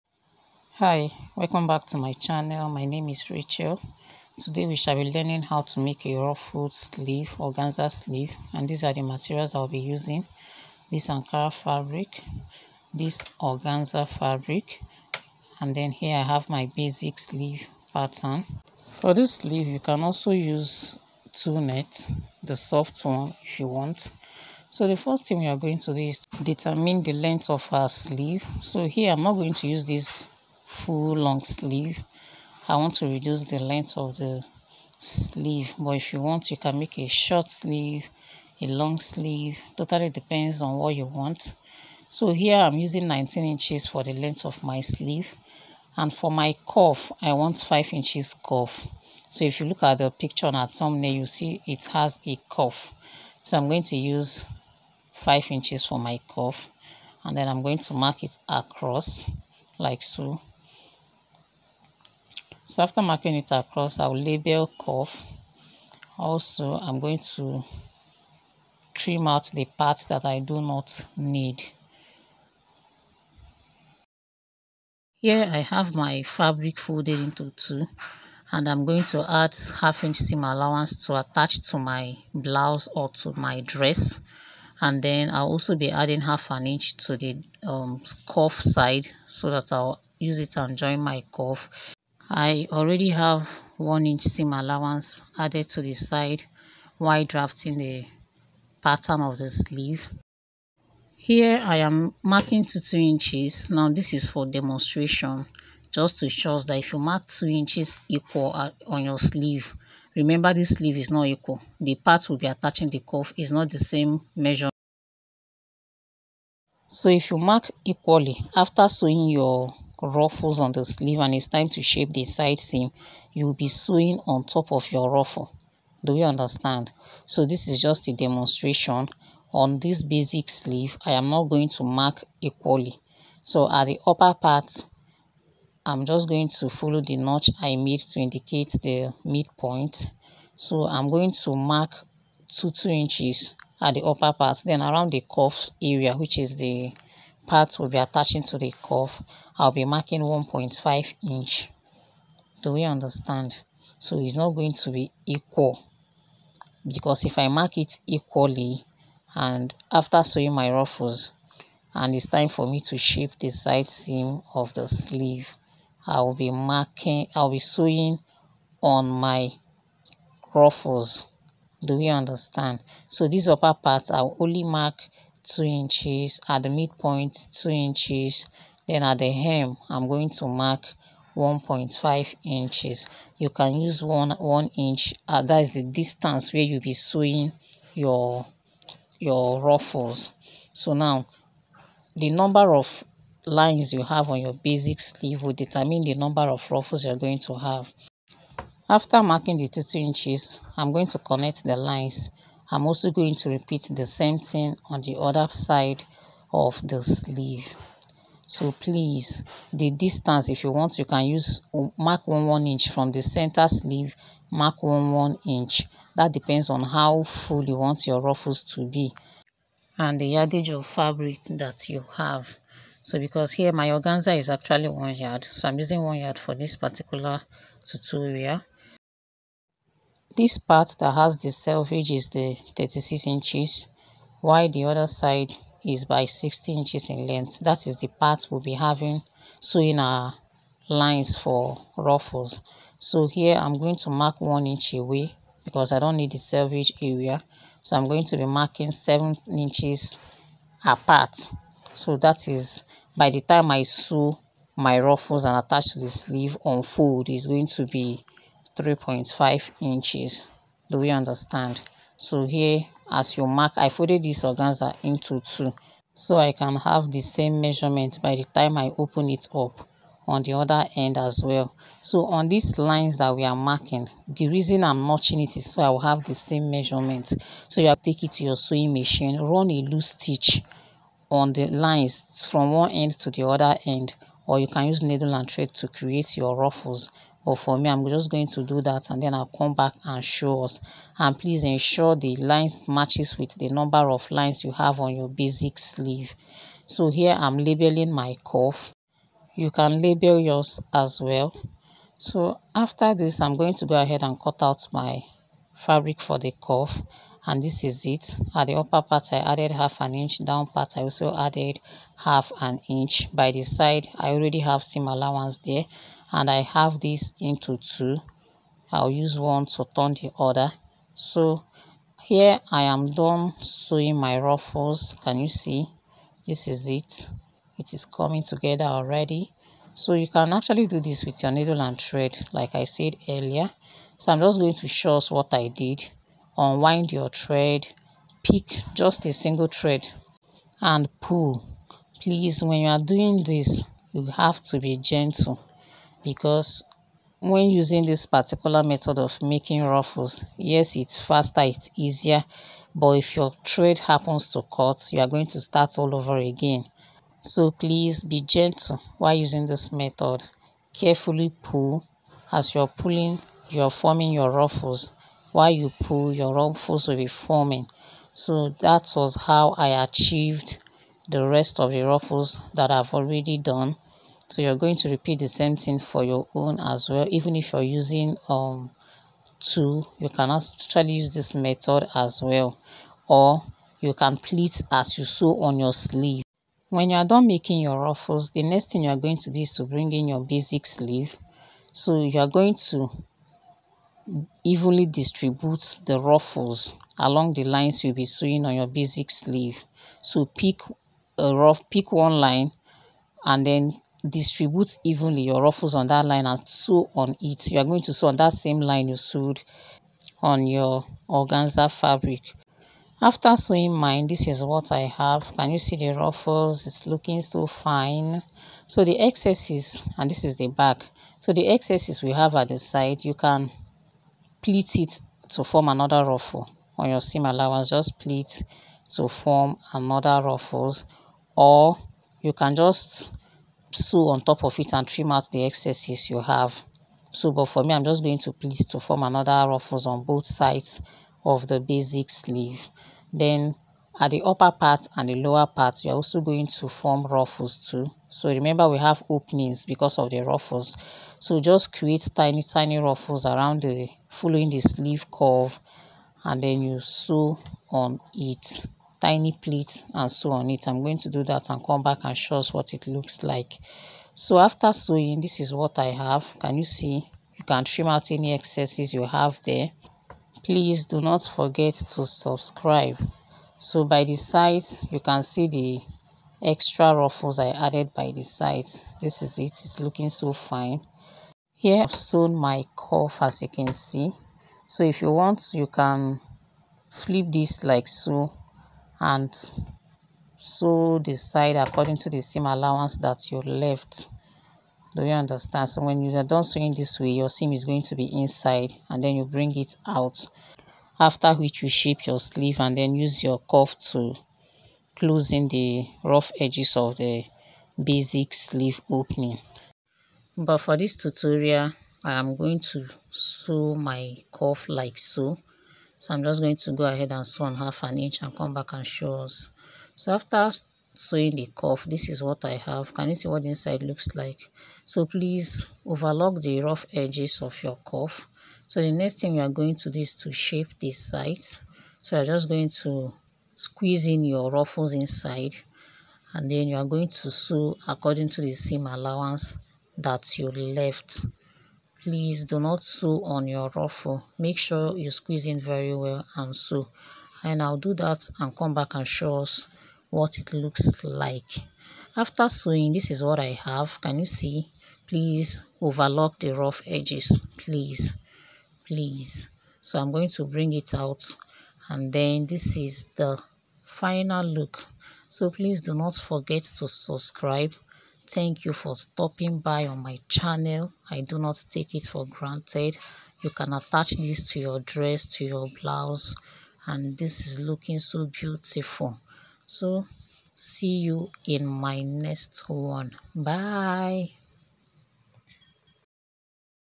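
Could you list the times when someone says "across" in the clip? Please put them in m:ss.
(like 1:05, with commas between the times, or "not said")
0:58, 1:03.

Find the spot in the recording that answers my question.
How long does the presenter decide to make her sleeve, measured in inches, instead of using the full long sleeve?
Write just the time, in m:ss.
0:43.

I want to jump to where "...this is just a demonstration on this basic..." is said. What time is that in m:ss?
2:07.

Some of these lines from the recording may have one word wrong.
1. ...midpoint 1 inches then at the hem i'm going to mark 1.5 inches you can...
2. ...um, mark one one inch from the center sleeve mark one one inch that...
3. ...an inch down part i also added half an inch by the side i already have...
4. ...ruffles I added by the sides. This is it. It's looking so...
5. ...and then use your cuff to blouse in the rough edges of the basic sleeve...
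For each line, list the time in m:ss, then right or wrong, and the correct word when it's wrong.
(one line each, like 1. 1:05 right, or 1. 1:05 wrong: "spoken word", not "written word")
1. 2:56 wrong: "2", not "1"
2. 3:31 right
3. 5:09 right
4. 7:57 right
5. 8:22 wrong: "close", not "blouse".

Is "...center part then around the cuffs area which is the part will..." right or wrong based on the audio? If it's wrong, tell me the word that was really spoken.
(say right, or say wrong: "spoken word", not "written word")
wrong: "upper", not "center".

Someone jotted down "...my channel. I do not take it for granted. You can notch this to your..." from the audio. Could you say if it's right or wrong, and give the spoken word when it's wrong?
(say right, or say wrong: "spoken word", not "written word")
wrong: "attach", not "notch".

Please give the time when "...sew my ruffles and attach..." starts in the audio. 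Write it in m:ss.
4:13.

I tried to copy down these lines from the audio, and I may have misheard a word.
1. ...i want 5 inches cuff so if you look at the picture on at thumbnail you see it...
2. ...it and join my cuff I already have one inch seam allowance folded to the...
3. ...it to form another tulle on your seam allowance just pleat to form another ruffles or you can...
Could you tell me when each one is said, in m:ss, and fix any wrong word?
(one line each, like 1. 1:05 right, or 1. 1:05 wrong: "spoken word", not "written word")
1. 0:47 right
2. 1:30 wrong: "added", not "folded"
3. 7:04 wrong: "ruffle", not "tulle".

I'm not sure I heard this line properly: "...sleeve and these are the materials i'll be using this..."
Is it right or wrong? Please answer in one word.
right.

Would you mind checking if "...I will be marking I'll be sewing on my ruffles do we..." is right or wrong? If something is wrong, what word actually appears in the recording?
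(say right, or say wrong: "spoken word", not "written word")
right.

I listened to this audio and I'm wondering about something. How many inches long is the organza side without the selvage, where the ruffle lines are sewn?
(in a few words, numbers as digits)
60 inches.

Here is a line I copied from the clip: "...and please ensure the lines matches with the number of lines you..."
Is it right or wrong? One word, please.
right.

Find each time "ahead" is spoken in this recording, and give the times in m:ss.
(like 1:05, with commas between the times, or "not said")
5:04, 8:37.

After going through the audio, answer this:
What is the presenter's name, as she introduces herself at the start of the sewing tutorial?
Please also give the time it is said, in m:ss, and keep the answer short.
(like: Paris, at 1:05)
Rachel, at 0:03.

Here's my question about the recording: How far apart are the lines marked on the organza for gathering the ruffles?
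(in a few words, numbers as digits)
7 inches.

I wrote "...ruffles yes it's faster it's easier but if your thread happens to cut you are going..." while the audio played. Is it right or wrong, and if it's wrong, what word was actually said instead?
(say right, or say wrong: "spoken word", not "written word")
right.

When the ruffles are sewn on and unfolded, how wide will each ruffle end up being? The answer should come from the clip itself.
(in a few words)
3.5 inches.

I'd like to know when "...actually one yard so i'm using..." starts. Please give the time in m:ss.
3:44.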